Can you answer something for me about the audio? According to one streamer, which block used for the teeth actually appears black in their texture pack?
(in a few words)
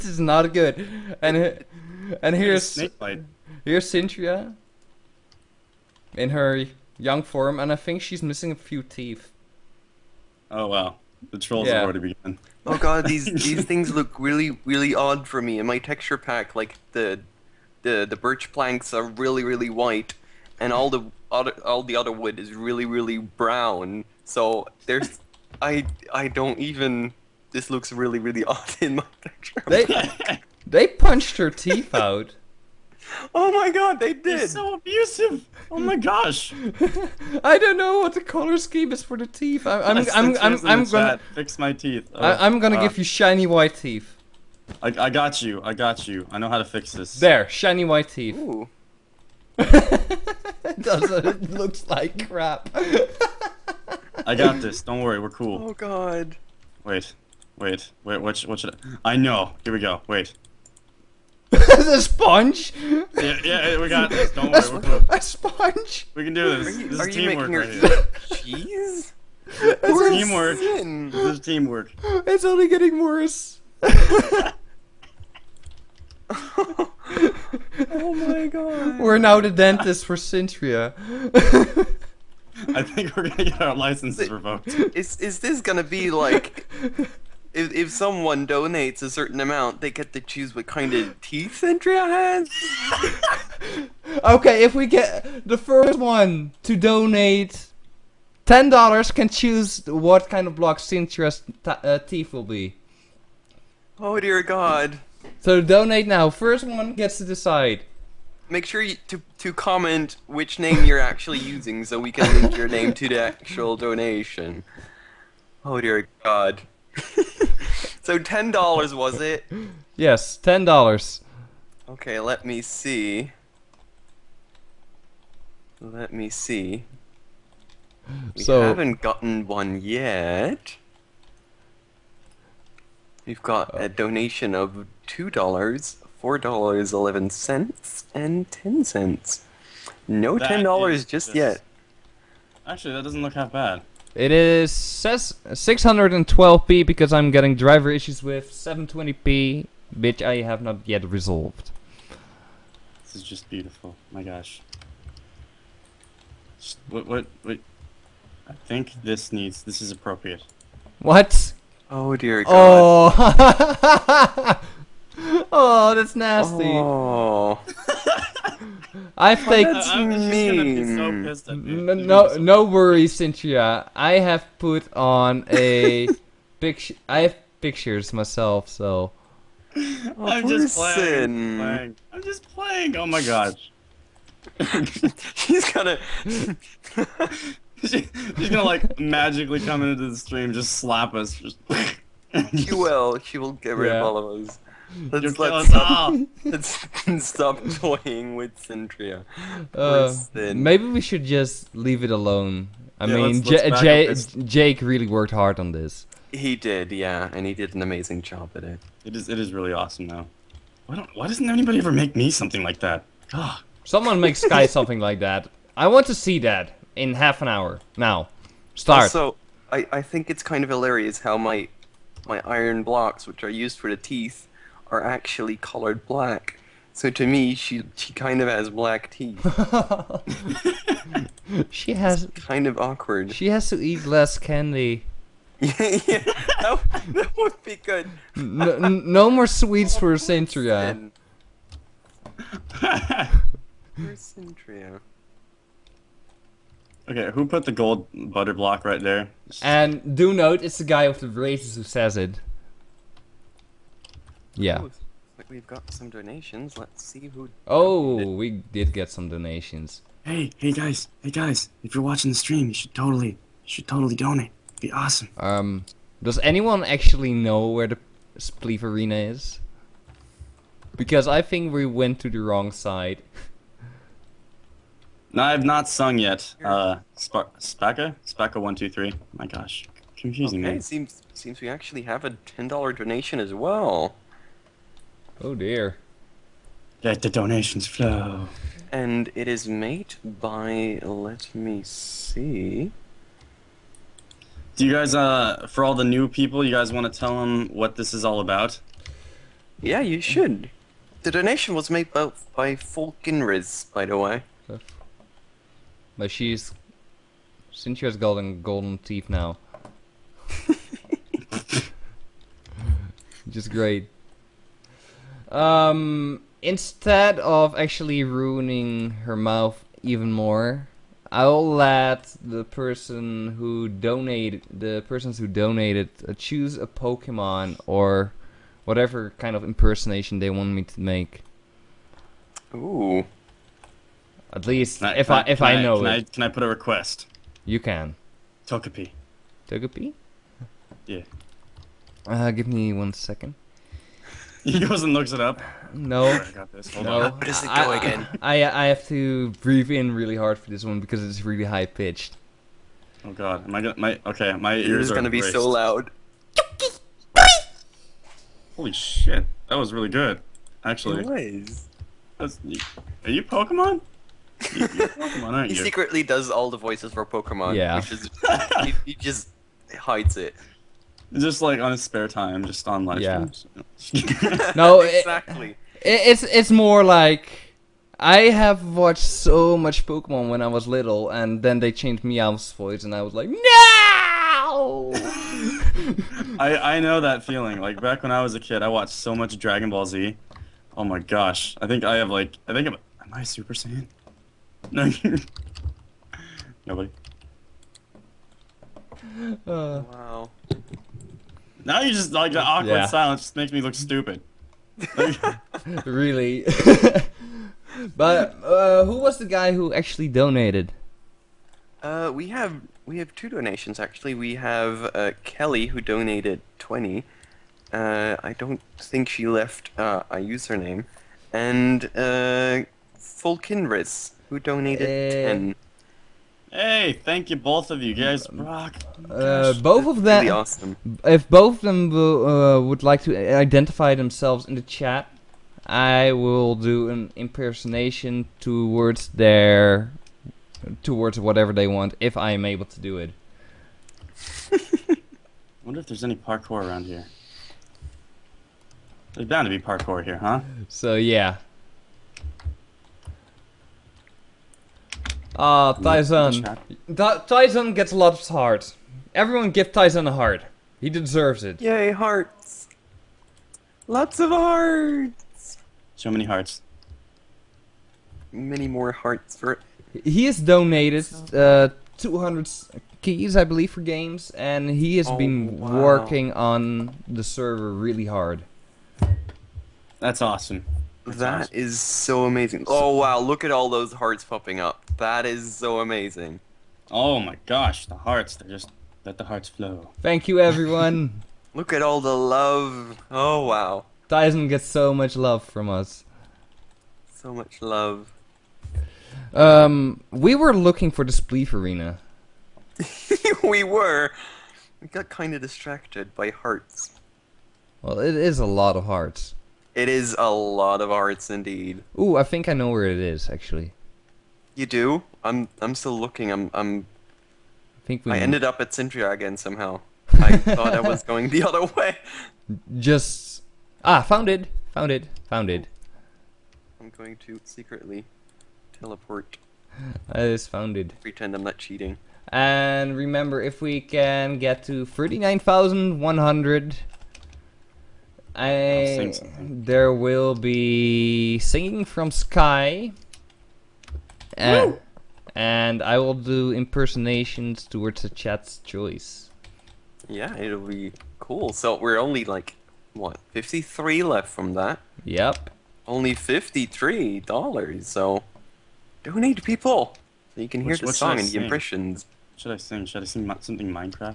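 iron blocks.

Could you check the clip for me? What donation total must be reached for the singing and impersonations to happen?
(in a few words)
39,100.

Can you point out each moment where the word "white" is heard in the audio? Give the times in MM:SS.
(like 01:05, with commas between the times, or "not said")
00:19, 00:43, 00:47.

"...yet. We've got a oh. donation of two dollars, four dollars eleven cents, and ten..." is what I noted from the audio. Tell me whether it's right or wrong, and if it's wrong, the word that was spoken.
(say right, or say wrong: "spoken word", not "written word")
right.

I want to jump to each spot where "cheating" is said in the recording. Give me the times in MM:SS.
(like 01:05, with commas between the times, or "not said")
08:51.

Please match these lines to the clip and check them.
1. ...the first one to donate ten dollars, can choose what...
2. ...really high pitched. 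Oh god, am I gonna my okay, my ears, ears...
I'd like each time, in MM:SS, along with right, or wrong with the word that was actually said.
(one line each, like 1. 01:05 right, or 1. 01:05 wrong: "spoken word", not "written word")
1. 01:35 right
2. 05:51 right.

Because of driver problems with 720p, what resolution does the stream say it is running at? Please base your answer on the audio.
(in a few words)
612p.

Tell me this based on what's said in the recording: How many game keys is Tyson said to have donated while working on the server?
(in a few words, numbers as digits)
200.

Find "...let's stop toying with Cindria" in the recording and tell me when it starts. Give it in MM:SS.
03:16.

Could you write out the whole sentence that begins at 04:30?
Because I think we went to the wrong side.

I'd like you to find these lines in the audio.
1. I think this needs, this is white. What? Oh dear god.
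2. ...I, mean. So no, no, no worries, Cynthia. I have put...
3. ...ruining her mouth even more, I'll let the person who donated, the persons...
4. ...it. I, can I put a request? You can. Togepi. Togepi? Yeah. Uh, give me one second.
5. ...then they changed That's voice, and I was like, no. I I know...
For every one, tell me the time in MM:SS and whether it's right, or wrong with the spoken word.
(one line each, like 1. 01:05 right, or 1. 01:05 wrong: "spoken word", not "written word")
1. 02:38 wrong: "appropriate", not "white"
2. 02:49 right
3. 05:18 right
4. 05:36 right
5. 06:21 wrong: "Meowth", not "That".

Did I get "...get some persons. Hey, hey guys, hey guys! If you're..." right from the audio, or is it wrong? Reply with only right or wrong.
wrong.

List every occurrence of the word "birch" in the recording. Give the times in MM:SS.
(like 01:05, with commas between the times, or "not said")
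00:18.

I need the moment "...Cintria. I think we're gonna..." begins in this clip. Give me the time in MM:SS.
01:20.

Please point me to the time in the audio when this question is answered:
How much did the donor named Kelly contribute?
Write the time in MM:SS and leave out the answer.
06:56.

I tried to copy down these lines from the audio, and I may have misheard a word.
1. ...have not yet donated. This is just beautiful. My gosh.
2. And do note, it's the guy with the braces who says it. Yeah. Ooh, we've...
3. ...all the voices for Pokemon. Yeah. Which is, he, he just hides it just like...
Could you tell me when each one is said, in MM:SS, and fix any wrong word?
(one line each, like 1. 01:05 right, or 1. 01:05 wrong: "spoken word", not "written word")
1. 02:30 wrong: "resolved", not "donated"
2. 04:09 right
3. 06:06 right.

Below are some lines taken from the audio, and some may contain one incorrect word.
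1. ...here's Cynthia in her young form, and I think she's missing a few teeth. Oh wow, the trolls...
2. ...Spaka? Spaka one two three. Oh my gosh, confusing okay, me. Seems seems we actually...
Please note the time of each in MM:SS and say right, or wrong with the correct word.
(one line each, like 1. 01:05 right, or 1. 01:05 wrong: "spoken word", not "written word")
1. 00:03 right
2. 04:37 right.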